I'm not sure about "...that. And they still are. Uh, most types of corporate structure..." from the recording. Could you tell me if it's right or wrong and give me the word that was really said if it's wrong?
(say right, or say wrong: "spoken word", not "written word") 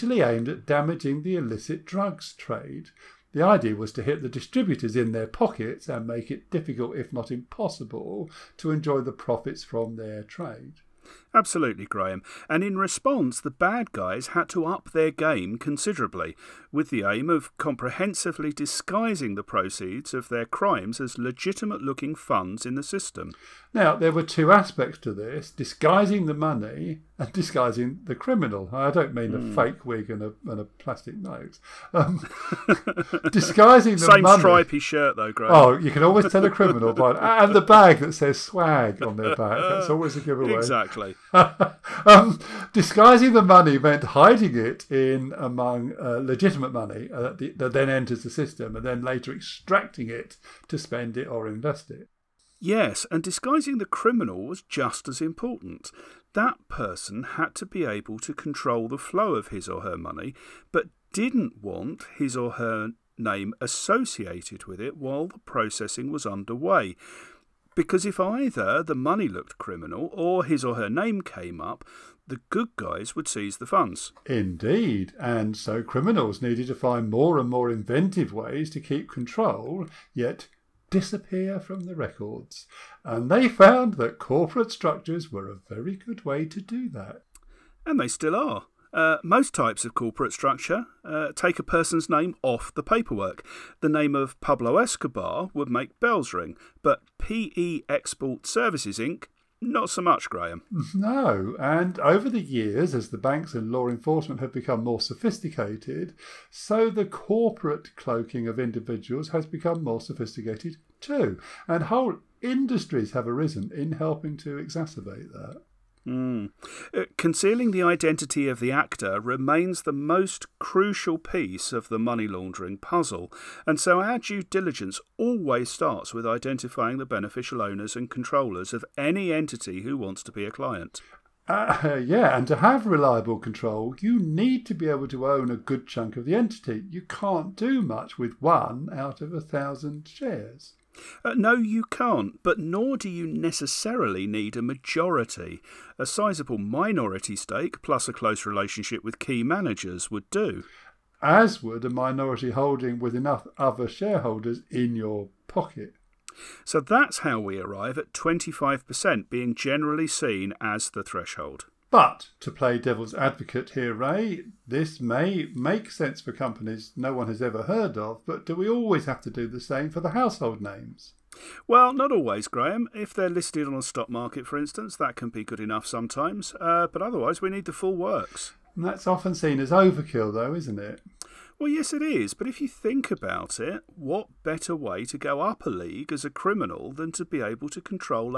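right.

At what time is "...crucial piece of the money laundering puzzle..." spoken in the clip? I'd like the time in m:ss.
2:00.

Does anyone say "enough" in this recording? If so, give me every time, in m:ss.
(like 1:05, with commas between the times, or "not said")
2:33, 2:55.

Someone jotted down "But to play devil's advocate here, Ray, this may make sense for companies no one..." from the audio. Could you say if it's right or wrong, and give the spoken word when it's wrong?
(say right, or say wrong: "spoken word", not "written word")
right.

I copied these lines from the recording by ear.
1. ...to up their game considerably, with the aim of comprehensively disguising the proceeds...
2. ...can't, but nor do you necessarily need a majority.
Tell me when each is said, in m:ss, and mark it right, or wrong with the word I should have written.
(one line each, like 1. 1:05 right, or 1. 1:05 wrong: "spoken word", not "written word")
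1. 0:14 right
2. 2:21 right.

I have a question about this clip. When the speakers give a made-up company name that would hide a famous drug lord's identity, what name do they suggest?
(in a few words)
PE Export Services Inc.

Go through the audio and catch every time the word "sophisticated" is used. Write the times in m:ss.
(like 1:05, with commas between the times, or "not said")
1:45, 1:50.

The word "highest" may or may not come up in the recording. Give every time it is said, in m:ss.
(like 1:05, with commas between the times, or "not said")
not said.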